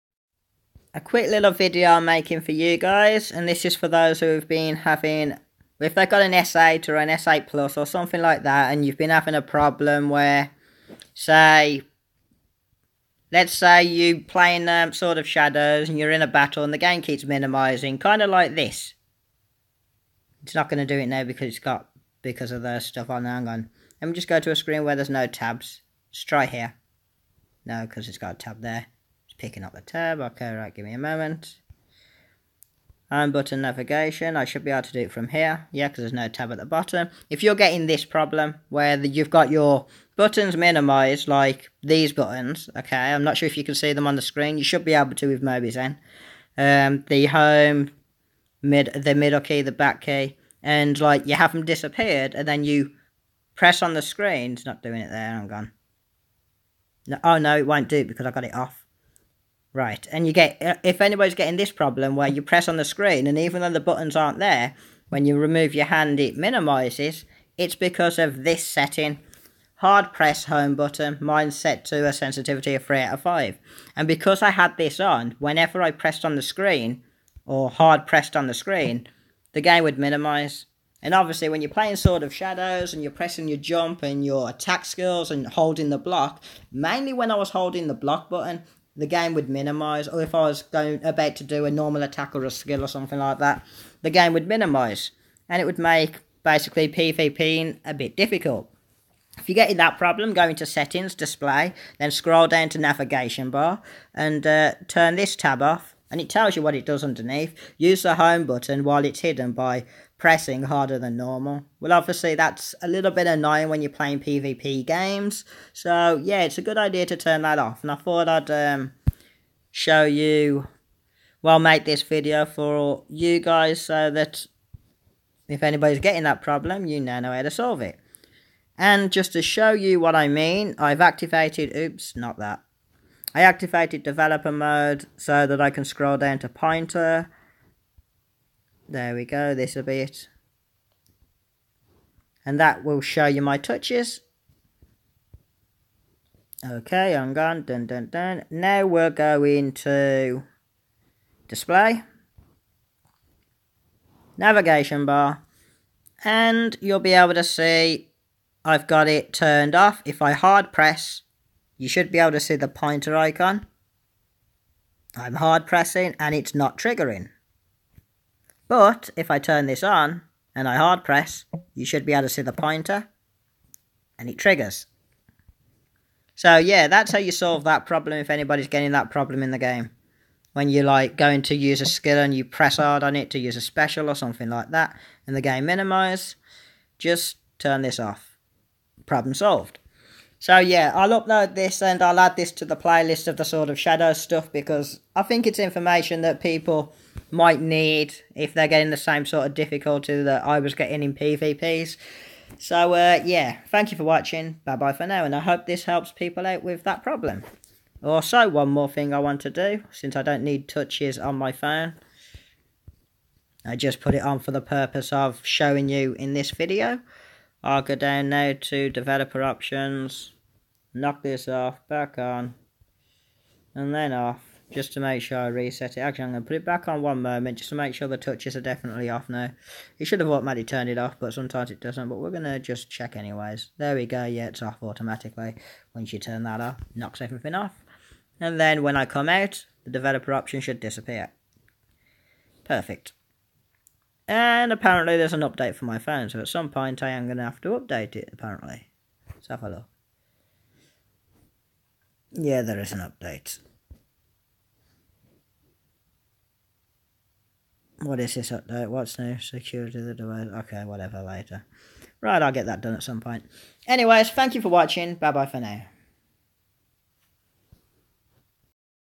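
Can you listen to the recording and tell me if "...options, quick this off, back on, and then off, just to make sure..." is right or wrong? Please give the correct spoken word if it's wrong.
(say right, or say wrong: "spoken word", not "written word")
wrong: "knock", not "quick".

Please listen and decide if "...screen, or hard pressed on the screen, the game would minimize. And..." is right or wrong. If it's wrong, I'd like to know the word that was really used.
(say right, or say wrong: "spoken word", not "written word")
right.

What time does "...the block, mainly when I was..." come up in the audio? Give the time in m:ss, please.
1:25.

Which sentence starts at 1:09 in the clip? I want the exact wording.
Hard press home button, mine's set to a sensitivity of 3 out of 5.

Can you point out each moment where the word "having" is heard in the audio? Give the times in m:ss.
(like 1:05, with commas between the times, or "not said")
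0:04, 0:09.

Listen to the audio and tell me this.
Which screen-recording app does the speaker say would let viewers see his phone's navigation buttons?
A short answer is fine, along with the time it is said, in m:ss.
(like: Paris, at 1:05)
Mobizen, at 0:45.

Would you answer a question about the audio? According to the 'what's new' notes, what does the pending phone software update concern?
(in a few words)
Security of the device.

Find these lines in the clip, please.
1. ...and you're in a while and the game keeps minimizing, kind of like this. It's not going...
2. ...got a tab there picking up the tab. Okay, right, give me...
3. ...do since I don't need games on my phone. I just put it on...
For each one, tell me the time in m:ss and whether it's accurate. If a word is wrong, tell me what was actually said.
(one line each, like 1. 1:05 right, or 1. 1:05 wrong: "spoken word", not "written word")
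1. 0:15 wrong: "battle", not "while"
2. 0:28 right
3. 3:29 wrong: "touches", not "games".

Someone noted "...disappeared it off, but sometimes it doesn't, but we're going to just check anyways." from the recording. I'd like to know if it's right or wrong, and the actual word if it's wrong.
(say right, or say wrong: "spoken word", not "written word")
wrong: "turned", not "disappeared".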